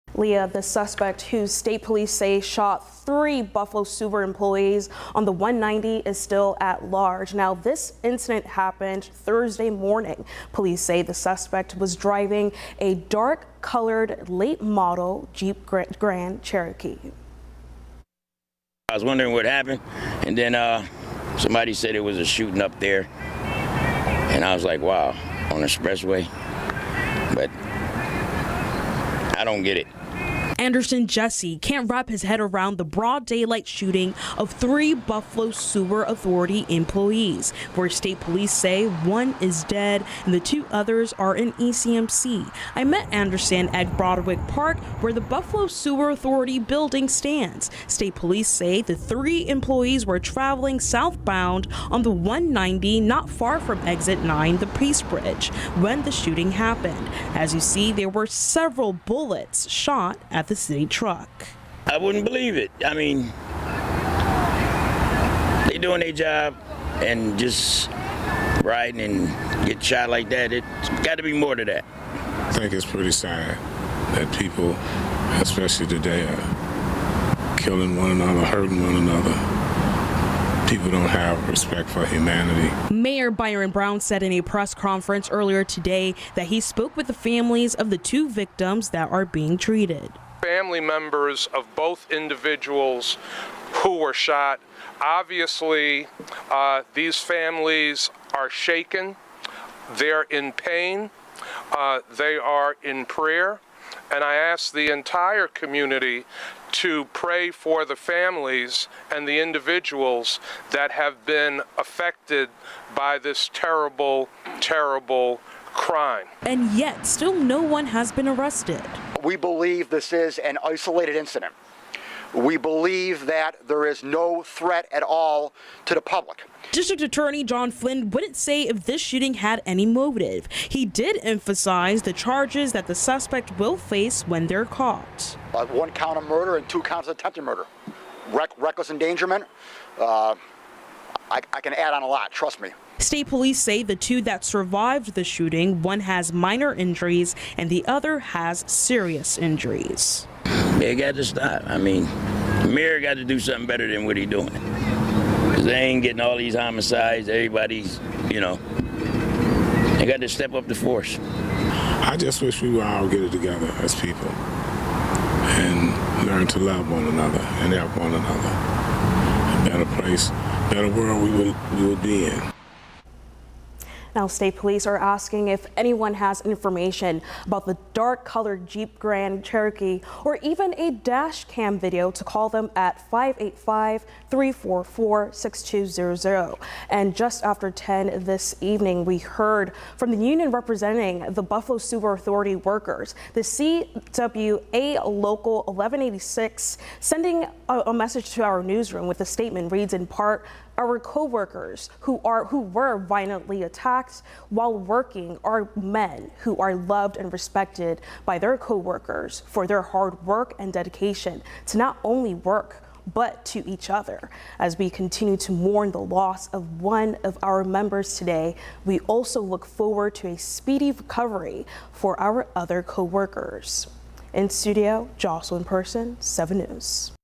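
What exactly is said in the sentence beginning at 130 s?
He did emphasize the charges that the suspect will face when they're caught.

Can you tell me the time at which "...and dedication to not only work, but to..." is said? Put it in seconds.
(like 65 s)
210 s.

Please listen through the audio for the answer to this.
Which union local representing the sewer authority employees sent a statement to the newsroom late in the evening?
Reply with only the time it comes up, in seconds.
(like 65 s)
193 s.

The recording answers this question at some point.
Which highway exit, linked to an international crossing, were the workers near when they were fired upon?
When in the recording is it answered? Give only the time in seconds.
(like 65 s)
53 s.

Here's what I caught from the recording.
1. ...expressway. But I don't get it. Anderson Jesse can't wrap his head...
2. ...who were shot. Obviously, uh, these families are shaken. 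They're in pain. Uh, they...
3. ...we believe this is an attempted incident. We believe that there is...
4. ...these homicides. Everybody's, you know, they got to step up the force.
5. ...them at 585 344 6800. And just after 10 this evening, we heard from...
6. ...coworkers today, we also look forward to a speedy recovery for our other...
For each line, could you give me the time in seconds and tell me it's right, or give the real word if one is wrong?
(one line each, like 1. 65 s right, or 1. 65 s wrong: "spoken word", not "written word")
1. 25 s right
2. 93 s right
3. 119 s wrong: "isolated", not "attempted"
4. 156 s right
5. 182 s wrong: "6200", not "6800"
6. 217 s wrong: "members", not "coworkers".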